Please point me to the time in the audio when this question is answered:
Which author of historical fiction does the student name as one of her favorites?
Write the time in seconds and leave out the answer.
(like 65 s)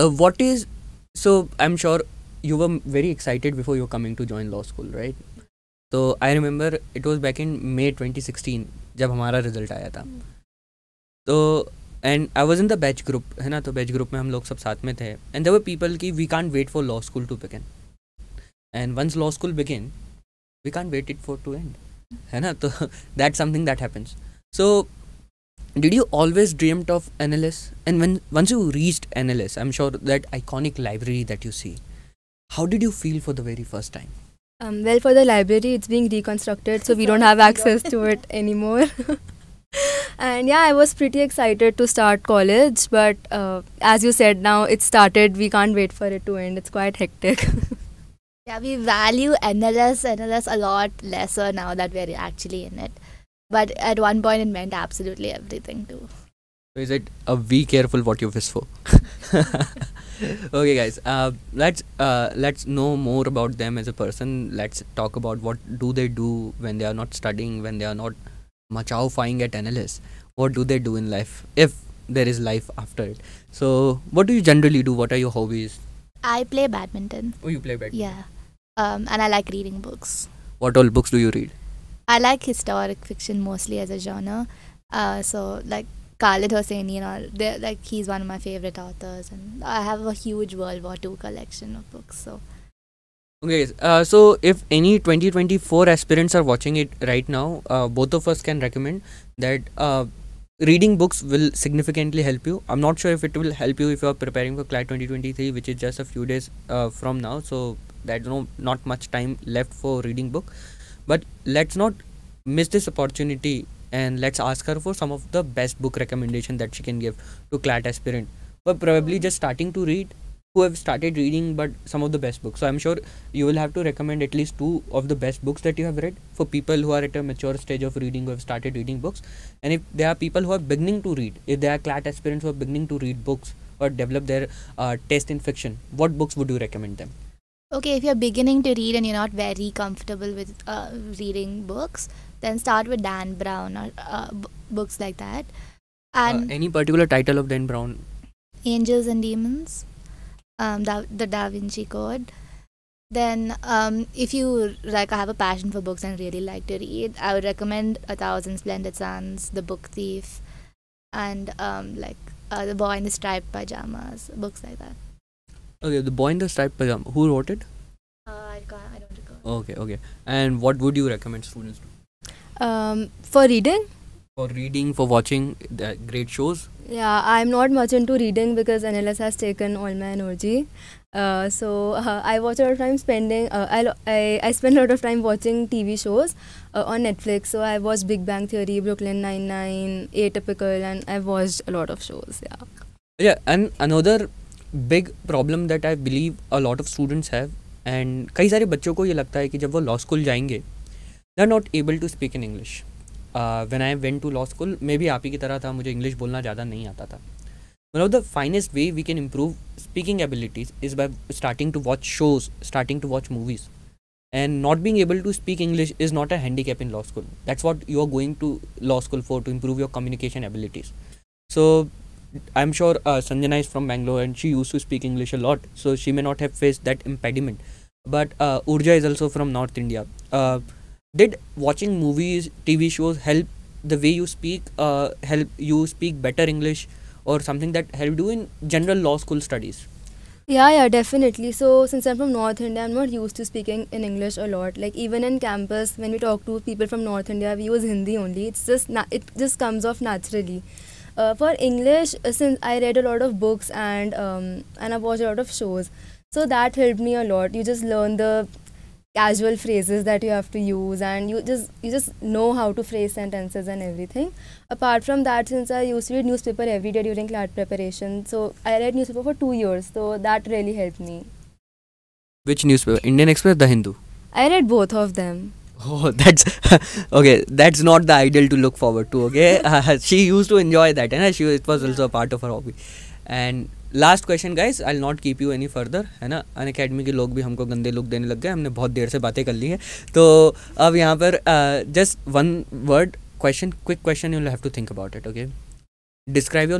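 86 s.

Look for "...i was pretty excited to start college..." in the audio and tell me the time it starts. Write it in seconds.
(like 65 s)
40 s.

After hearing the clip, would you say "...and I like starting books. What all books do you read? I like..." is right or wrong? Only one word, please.
wrong.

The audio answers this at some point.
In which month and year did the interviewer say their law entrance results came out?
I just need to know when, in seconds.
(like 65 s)
7 s.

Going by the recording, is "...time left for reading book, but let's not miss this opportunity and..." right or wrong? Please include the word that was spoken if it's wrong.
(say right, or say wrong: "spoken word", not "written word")
right.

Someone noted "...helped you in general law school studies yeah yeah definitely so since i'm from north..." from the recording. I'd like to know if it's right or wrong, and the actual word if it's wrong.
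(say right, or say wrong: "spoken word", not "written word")
right.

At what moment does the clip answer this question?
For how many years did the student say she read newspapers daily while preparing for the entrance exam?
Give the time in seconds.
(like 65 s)
269 s.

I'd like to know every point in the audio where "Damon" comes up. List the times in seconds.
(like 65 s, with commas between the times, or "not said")
not said.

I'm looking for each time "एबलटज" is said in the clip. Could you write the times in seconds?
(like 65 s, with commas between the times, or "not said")
210 s, 220 s.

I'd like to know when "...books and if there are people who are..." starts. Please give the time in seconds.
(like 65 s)
129 s.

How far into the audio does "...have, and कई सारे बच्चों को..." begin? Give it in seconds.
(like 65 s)
197 s.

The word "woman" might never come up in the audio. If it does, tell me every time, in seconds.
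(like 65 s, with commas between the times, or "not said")
not said.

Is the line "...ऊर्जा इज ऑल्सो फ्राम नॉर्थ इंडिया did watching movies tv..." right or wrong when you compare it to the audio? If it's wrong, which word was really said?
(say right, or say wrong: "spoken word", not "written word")
right.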